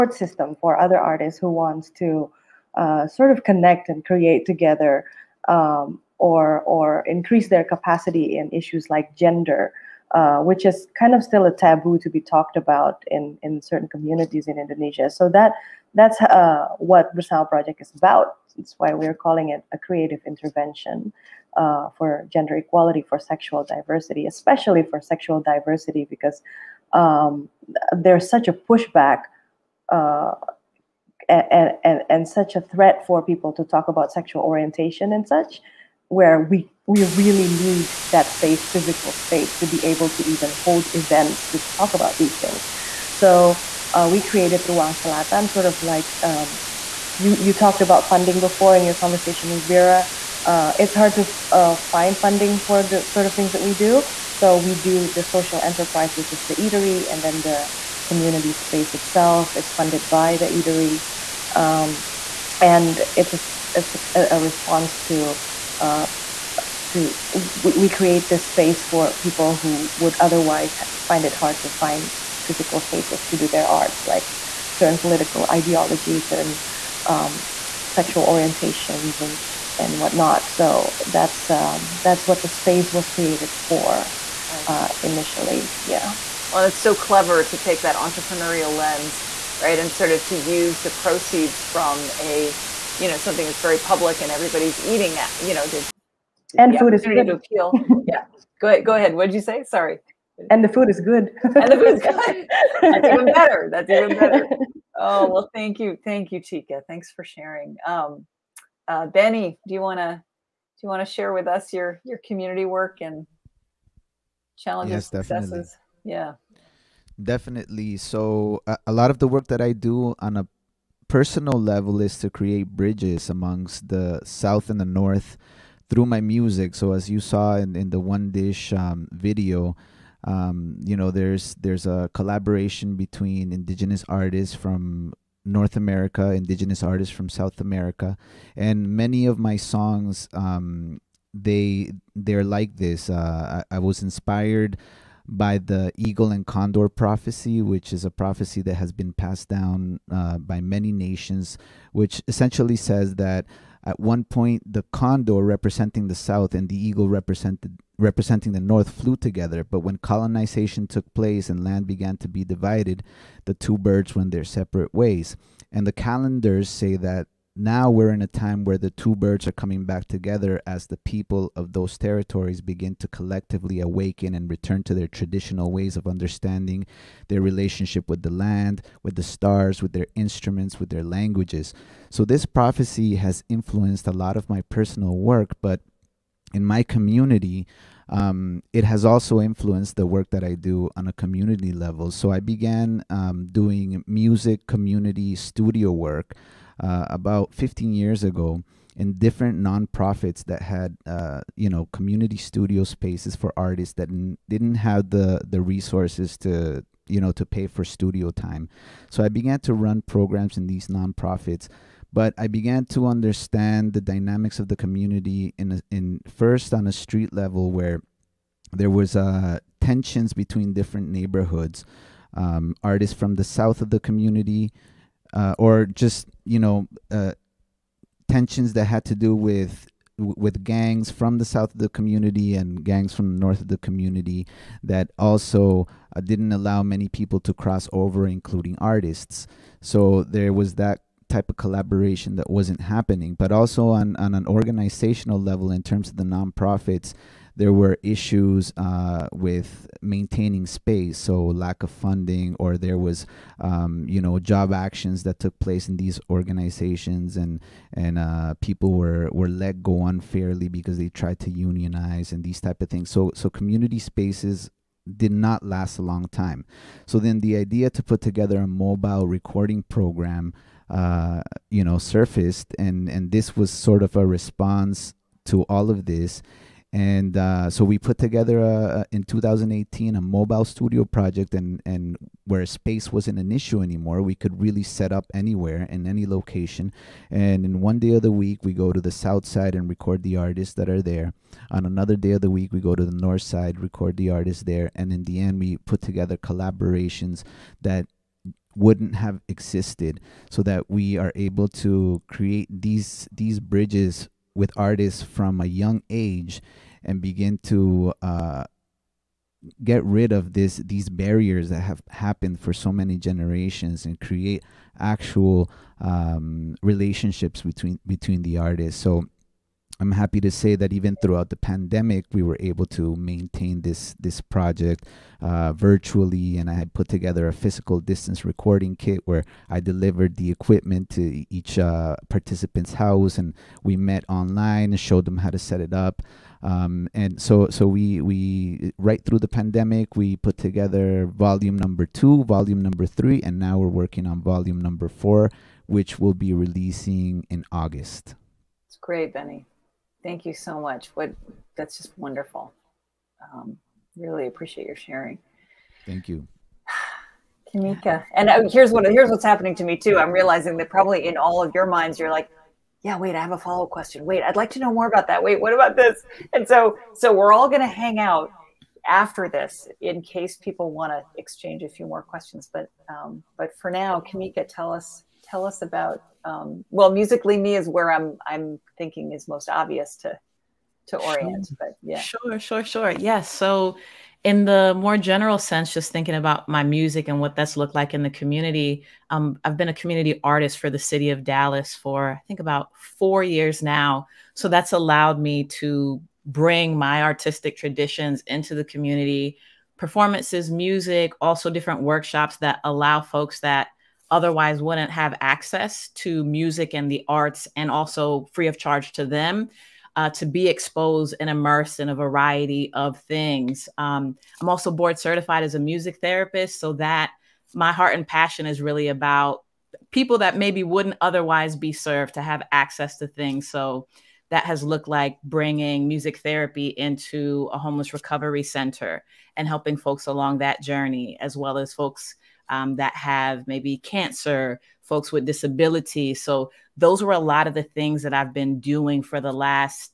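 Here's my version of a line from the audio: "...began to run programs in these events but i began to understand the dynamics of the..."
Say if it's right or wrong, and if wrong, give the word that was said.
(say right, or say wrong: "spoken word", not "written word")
wrong: "nonprofits", not "events".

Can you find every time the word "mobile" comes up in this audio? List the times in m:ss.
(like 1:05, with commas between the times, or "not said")
4:28, 4:40.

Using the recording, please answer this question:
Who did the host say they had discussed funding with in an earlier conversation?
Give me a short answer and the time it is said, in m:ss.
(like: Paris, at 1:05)
Vera, at 0:49.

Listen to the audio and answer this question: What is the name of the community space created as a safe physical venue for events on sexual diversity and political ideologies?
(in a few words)
Ruang Selatan.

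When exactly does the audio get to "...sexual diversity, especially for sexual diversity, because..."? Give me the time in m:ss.
0:23.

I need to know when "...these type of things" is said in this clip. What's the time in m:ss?
4:22.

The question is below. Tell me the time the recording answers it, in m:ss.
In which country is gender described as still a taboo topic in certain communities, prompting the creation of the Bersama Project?
0:14.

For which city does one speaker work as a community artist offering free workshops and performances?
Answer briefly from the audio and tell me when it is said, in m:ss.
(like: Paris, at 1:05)
Dallas, at 6:30.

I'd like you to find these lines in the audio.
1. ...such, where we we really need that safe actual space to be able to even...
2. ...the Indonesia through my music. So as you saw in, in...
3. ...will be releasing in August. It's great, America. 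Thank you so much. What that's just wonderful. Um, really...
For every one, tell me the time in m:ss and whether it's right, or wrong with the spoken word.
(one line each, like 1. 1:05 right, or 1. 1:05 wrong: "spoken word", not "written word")
1. 0:35 wrong: "physical", not "actual"
2. 2:04 wrong: "North", not "Indonesia"
3. 5:46 wrong: "Beny", not "America".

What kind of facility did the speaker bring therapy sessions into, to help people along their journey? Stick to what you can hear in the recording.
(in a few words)
Homeless recovery center.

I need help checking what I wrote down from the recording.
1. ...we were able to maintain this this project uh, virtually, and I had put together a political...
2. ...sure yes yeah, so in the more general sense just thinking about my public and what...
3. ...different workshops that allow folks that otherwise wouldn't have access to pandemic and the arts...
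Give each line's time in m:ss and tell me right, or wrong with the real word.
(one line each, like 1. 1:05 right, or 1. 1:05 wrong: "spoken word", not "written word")
1. 5:22 wrong: "physical", not "political"
2. 6:22 wrong: "music", not "public"
3. 6:41 wrong: "music", not "pandemic".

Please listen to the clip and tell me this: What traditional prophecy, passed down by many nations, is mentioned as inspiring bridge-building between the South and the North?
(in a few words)
Eagle and condor prophecy.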